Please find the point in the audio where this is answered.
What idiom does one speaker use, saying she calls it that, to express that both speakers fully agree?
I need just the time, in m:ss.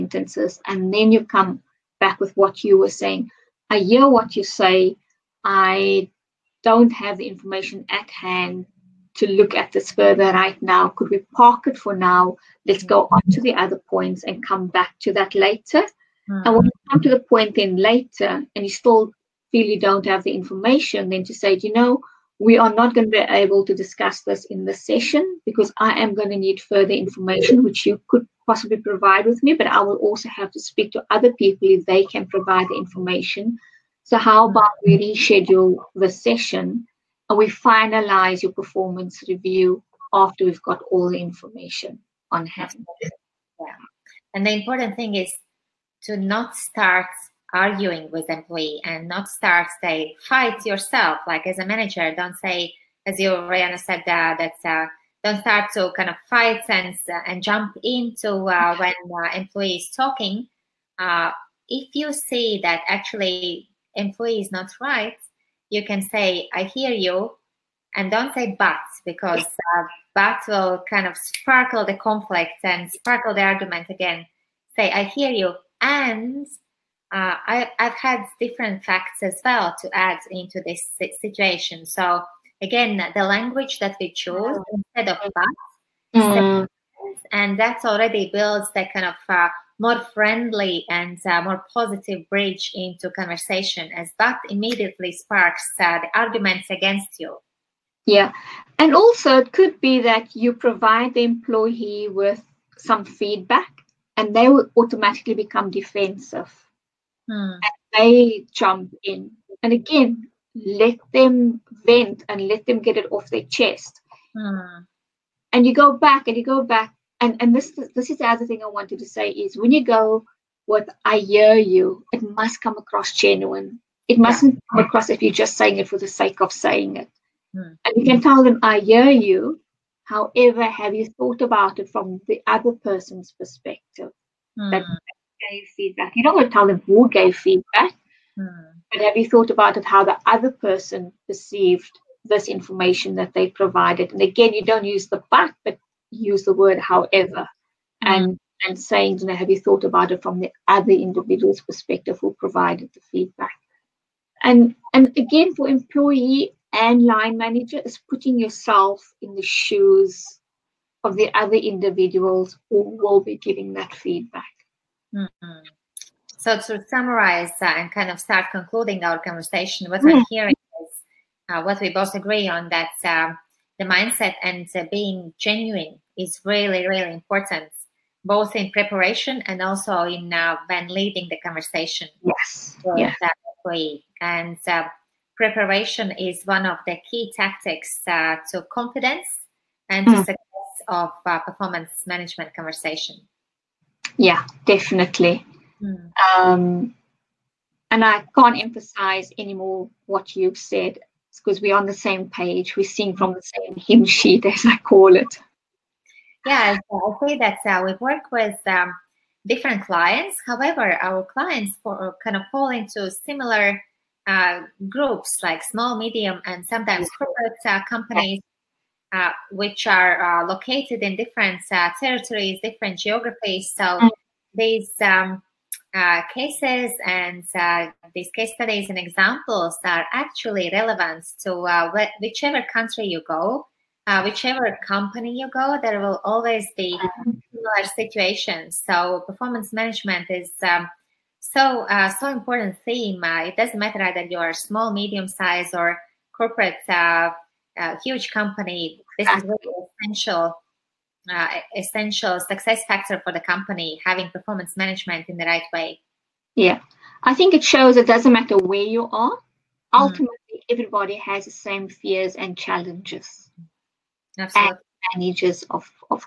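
3:23.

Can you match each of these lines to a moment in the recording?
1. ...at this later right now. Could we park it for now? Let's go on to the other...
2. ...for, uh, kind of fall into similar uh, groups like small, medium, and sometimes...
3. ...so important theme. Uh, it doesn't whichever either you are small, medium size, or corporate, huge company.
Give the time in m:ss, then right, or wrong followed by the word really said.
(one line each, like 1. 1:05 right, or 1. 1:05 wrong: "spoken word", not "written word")
1. 0:09 wrong: "further", not "later"
2. 3:31 right
3. 4:02 wrong: "matter", not "whichever".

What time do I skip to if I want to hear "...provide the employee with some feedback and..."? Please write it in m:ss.
1:40.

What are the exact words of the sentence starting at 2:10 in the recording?
However, have you thought about it from the other person's perspective?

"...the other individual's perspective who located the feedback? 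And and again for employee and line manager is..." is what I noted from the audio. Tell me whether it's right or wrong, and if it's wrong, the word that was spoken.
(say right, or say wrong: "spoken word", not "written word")
wrong: "provided", not "located".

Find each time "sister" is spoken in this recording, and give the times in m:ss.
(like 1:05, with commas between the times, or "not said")
not said.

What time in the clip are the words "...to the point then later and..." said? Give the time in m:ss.
0:17.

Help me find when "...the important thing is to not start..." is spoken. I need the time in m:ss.
0:44.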